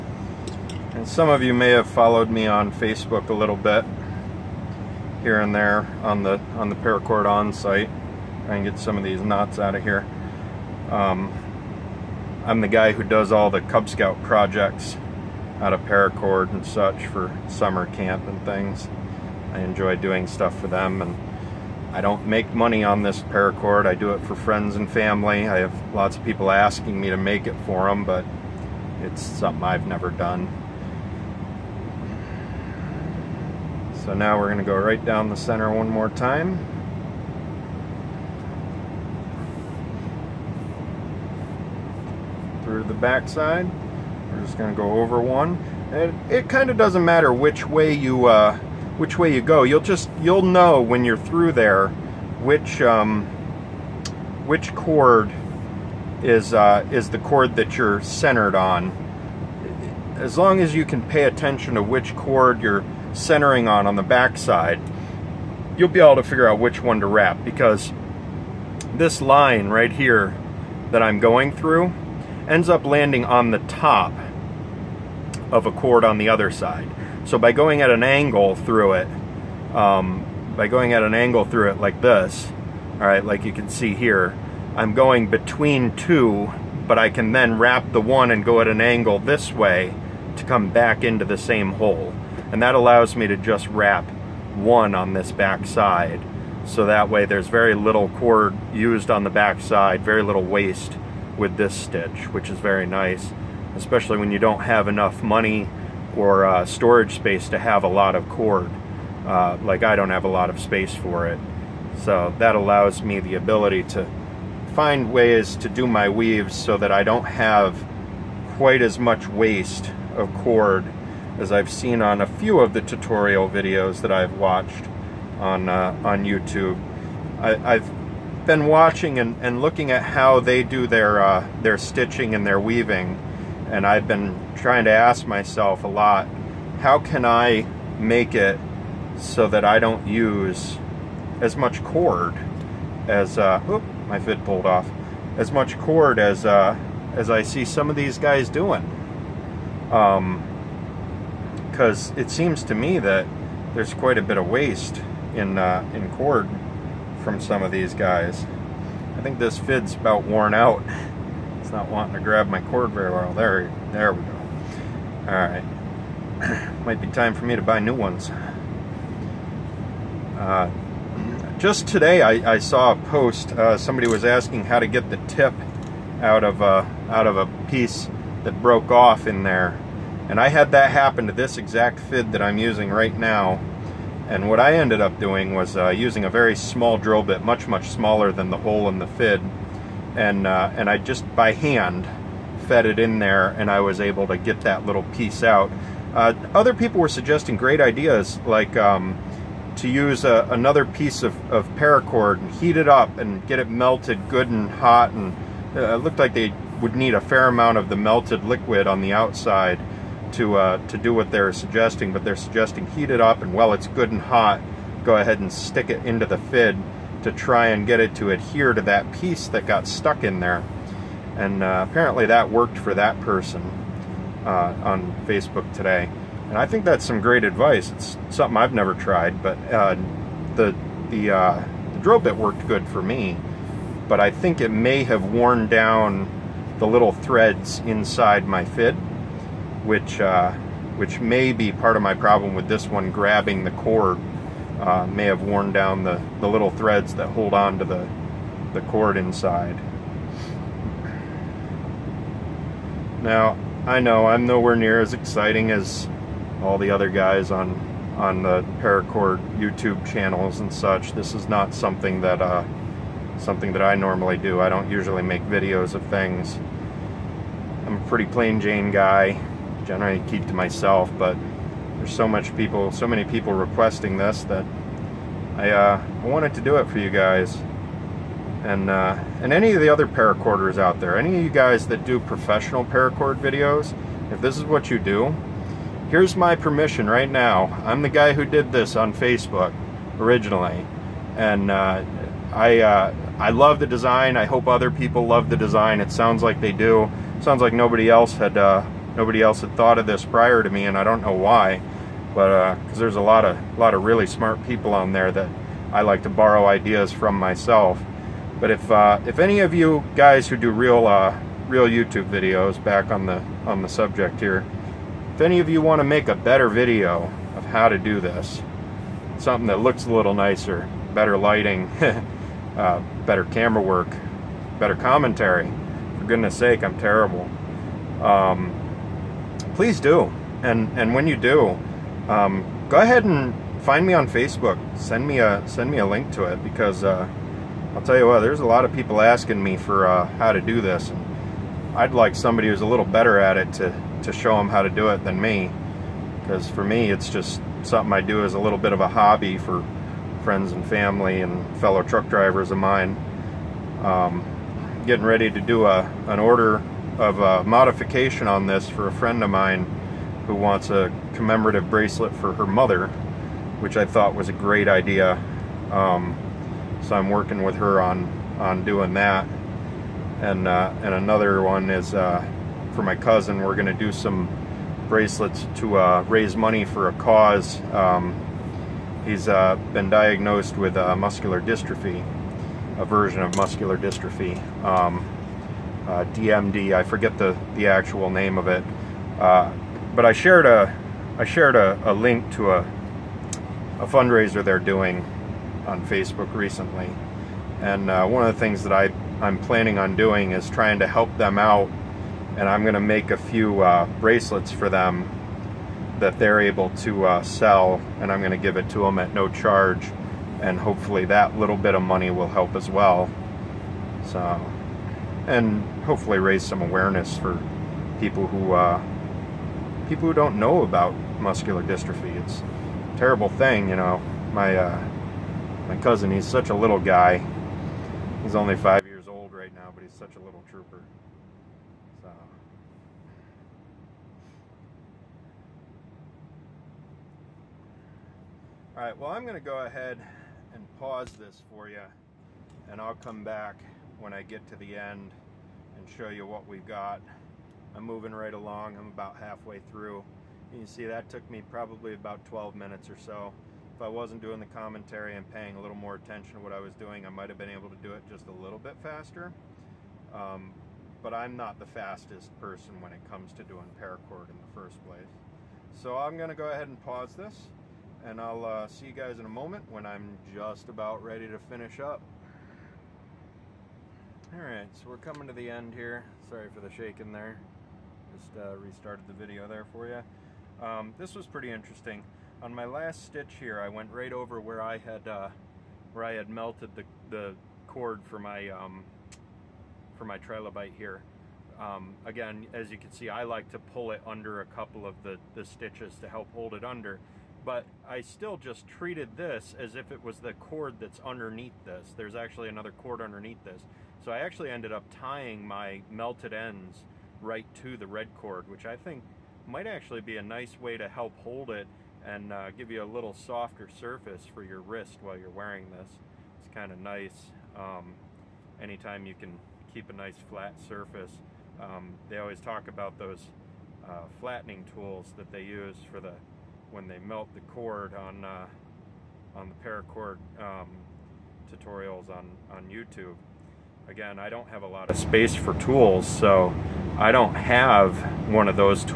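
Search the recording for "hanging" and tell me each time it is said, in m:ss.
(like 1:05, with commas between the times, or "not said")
not said.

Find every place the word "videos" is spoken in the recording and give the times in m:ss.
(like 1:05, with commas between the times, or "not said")
2:03, 4:25, 4:43, 5:12, 5:16, 7:59.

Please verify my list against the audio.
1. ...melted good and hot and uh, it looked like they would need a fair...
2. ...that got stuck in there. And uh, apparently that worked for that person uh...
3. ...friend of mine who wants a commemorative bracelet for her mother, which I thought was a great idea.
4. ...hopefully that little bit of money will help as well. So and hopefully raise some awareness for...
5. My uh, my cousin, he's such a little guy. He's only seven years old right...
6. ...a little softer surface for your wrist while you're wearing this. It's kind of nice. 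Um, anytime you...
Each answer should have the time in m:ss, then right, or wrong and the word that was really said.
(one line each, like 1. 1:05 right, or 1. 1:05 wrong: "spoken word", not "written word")
1. 3:23 right
2. 3:39 right
3. 5:59 right
4. 6:50 right
5. 7:04 wrong: "five", not "seven"
6. 8:33 right.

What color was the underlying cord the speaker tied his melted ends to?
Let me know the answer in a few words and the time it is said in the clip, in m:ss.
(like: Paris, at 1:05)
Red, at 8:28.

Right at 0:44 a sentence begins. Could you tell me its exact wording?
We're just going to go over one.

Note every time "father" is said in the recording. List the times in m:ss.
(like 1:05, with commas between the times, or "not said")
not said.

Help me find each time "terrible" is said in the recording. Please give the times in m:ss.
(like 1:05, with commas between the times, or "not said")
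5:26, 7:03.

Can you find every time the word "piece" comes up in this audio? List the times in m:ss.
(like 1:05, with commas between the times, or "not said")
2:57, 3:15, 3:20, 3:39.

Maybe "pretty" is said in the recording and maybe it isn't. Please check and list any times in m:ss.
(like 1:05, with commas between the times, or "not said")
4:28, 8:01.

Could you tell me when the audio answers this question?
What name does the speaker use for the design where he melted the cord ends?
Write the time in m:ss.
8:10.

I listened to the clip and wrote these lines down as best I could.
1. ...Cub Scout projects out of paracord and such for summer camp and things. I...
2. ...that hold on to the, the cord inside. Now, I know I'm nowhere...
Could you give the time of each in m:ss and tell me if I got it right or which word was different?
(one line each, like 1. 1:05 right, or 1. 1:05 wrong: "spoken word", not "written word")
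1. 0:13 right
2. 4:07 right.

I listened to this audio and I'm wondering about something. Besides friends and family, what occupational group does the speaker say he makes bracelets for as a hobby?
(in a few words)
Fellow truck drivers.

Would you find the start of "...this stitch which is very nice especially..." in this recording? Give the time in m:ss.
1:41.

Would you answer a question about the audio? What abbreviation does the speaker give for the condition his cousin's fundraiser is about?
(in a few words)
DMD.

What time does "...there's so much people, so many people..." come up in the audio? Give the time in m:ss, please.
4:31.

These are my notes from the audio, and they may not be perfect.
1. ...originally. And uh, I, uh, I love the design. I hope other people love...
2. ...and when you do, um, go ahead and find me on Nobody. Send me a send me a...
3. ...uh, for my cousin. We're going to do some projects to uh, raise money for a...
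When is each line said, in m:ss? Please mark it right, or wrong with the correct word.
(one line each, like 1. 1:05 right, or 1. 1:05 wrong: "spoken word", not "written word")
1. 4:50 right
2. 5:30 wrong: "Facebook", not "Nobody"
3. 6:12 wrong: "bracelets", not "projects".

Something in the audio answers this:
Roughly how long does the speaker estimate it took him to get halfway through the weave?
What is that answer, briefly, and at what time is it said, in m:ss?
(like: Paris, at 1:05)
12 minutes, at 7:32.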